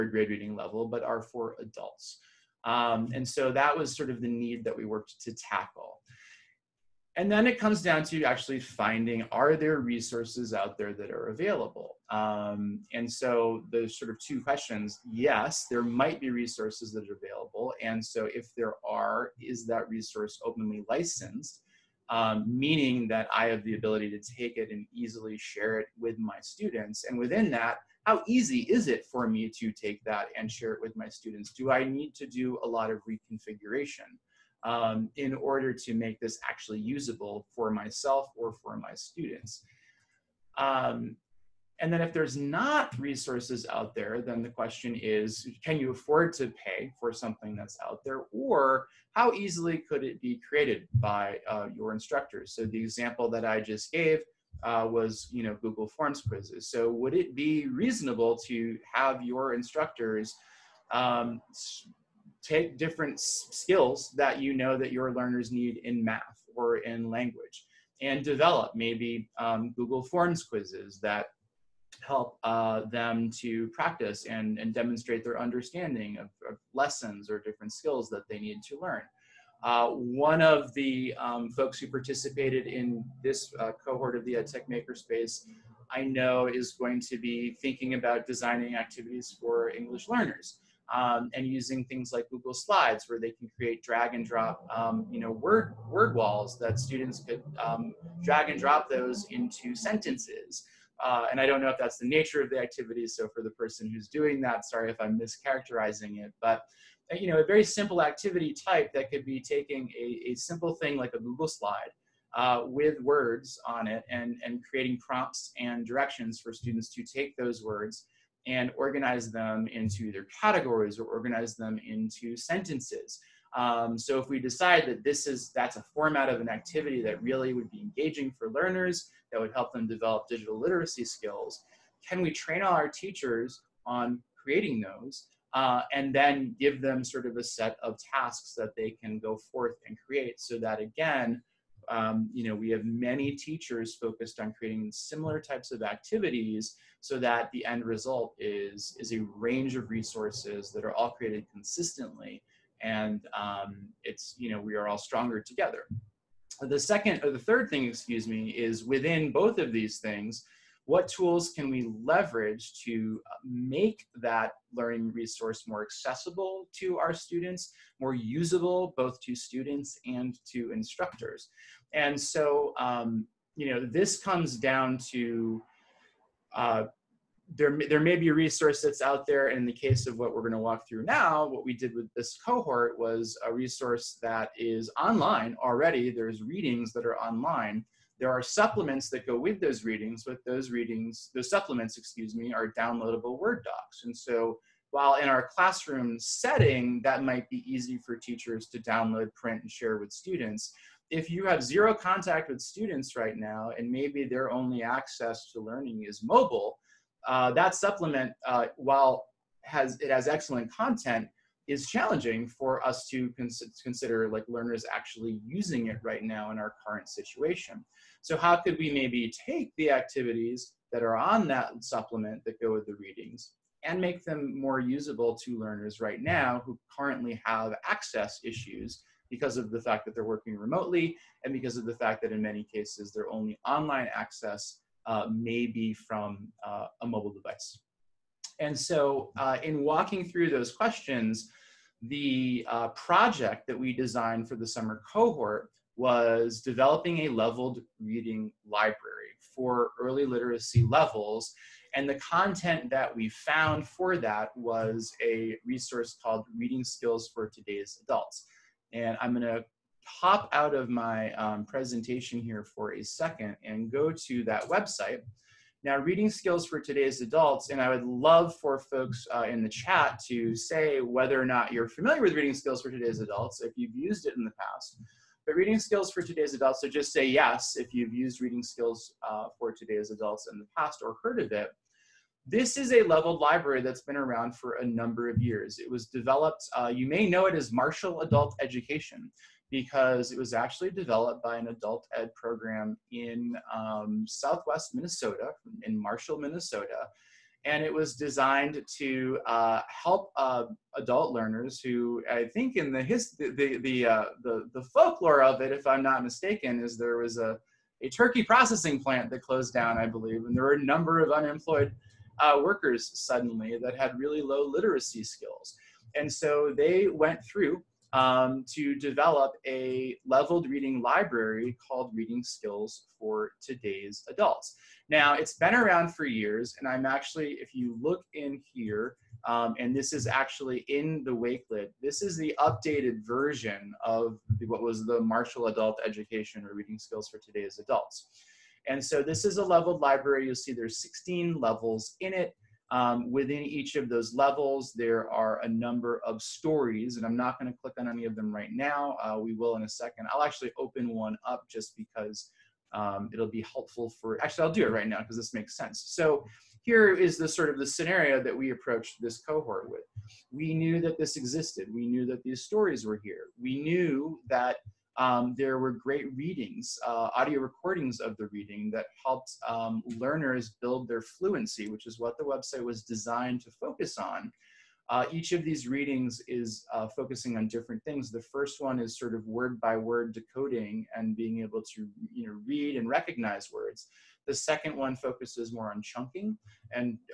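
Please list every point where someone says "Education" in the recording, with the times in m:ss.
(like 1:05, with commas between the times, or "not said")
4:48, 5:36.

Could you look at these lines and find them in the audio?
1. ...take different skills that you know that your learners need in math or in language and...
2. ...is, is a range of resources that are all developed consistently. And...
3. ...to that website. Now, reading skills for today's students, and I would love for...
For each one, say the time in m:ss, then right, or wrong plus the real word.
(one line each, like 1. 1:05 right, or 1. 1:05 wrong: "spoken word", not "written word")
1. 1:02 right
2. 2:28 wrong: "created", not "developed"
3. 4:24 wrong: "adults", not "students".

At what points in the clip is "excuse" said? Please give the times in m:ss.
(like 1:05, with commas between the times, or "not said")
2:37, 3:11.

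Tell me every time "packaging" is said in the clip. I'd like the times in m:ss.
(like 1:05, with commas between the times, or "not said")
not said.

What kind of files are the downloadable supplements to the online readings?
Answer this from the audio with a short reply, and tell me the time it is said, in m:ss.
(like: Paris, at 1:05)
Word docs, at 3:13.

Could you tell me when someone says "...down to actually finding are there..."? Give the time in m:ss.
0:07.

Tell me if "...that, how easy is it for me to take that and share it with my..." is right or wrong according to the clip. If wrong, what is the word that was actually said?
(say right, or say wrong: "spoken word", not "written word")
right.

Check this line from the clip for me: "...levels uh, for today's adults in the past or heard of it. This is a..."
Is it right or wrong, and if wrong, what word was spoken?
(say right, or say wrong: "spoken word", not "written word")
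wrong: "skills", not "levels".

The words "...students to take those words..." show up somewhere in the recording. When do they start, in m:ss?
1:56.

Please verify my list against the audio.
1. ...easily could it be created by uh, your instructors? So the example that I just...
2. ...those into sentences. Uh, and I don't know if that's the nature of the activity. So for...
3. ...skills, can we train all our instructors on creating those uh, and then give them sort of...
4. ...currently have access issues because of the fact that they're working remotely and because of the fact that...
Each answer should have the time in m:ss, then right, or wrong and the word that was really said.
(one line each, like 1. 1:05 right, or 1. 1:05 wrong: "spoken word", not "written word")
1. 0:49 right
2. 1:38 right
3. 2:11 wrong: "teachers", not "instructors"
4. 3:46 right.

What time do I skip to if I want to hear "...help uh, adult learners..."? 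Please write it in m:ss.
4:59.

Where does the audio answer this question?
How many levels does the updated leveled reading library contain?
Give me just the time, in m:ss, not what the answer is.
5:41.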